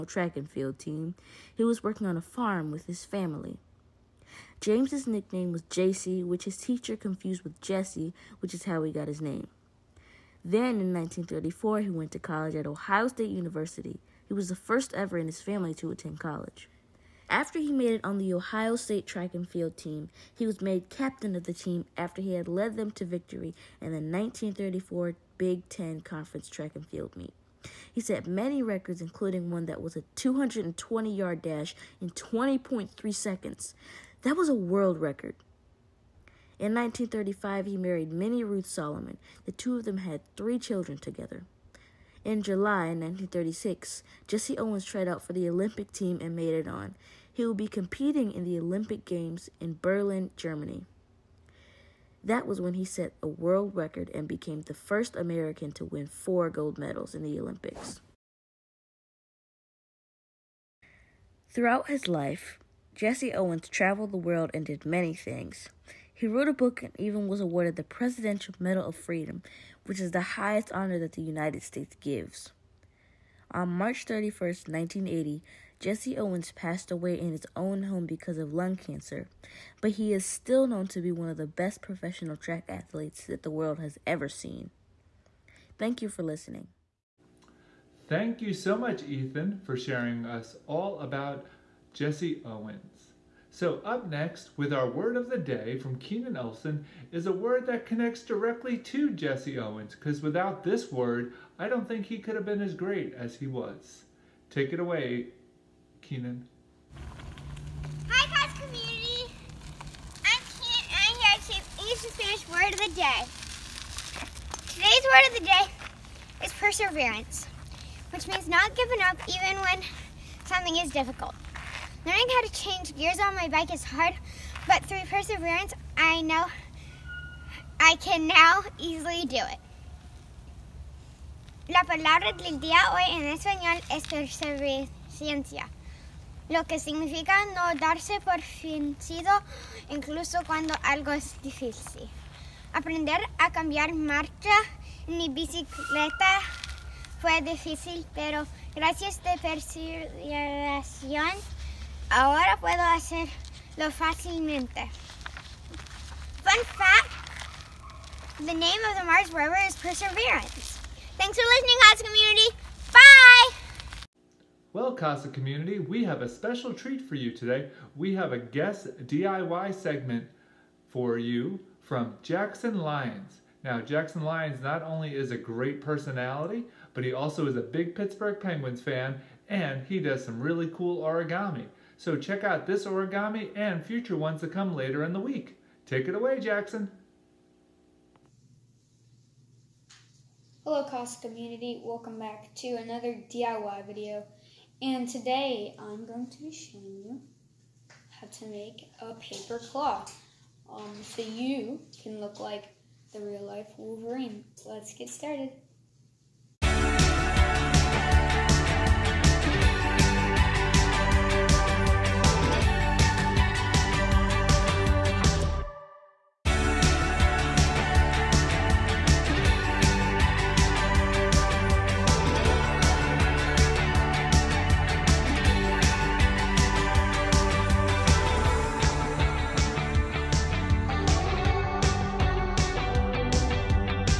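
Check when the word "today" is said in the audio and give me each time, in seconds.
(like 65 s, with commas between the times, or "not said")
114 s, 167 s, 195 s.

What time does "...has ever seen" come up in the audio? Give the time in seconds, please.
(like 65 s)
83 s.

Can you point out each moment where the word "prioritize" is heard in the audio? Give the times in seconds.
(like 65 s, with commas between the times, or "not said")
not said.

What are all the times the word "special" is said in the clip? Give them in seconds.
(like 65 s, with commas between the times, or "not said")
166 s.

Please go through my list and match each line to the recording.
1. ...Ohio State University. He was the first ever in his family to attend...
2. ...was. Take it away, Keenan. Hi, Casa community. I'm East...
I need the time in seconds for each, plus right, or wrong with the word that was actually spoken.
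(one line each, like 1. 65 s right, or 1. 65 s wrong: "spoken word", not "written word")
1. 12 s right
2. 103 s wrong: "Keenan", not "East".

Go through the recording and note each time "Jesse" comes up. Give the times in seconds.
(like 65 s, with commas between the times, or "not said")
7 s, 44 s, 62 s, 75 s, 91 s, 99 s.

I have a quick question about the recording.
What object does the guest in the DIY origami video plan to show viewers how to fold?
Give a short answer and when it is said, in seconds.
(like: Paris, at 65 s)
a paper claw, at 199 s.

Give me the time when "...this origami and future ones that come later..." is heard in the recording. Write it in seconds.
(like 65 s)
182 s.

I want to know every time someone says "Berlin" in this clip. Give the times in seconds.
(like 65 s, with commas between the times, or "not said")
49 s.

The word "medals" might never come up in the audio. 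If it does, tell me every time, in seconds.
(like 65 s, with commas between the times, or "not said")
56 s, 68 s.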